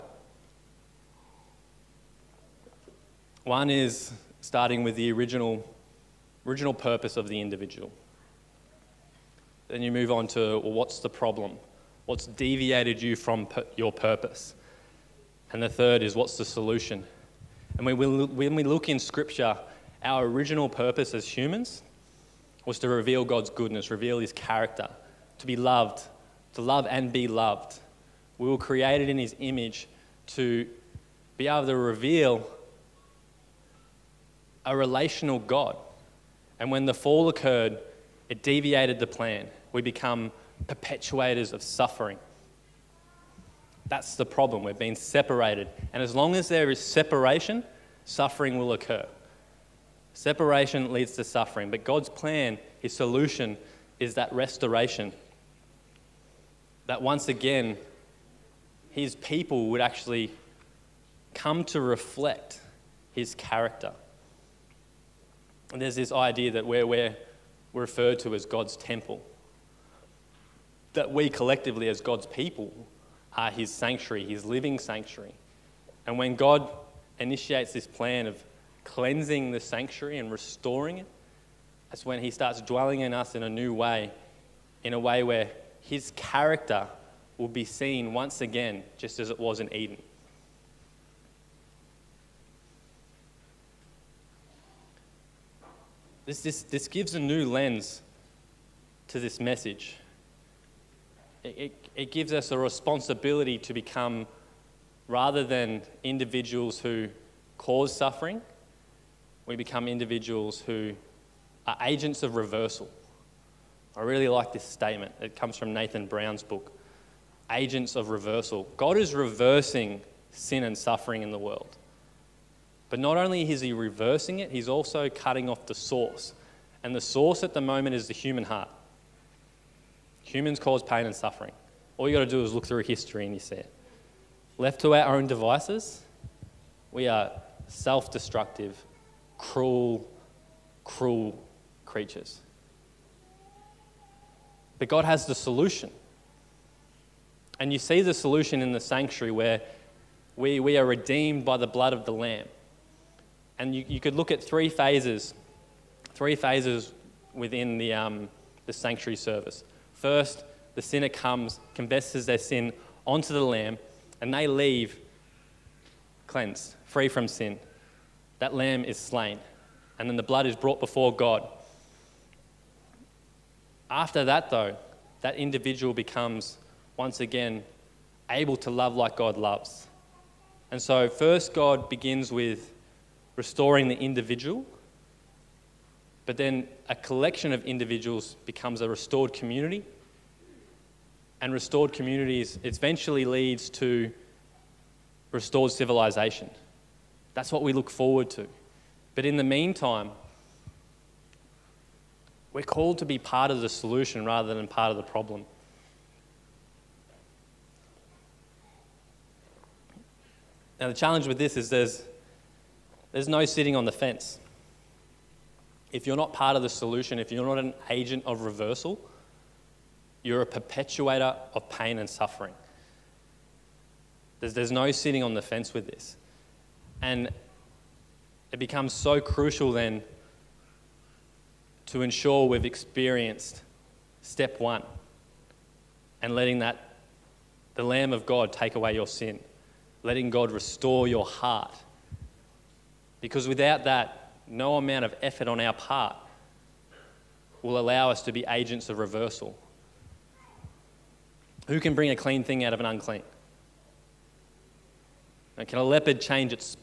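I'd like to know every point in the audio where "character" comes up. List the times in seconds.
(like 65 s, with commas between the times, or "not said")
24 s, 63 s, 86 s.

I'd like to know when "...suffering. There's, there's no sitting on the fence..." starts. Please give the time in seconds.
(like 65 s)
222 s.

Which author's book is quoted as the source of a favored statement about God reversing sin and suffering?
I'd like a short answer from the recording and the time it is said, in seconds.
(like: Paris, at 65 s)
Nathan Brown, at 115 s.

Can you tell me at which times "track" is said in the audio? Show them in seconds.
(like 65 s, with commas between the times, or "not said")
not said.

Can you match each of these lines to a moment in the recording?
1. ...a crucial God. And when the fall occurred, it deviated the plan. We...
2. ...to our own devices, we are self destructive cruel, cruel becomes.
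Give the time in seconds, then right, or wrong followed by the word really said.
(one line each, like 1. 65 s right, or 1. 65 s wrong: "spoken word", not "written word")
1. 34 s wrong: "relational", not "crucial"
2. 134 s wrong: "creatures", not "becomes".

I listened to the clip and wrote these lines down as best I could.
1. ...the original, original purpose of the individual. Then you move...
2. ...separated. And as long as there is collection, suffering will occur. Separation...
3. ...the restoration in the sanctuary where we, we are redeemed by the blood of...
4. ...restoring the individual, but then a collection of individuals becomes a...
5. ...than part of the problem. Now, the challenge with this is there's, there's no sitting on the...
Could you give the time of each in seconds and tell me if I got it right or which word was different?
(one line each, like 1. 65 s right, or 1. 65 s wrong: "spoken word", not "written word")
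1. 4 s right
2. 44 s wrong: "separation", not "collection"
3. 148 s wrong: "solution", not "restoration"
4. 183 s right
5. 204 s right.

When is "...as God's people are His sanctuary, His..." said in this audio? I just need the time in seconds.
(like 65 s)
71 s.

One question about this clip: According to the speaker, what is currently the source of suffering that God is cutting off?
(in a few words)
the human heart.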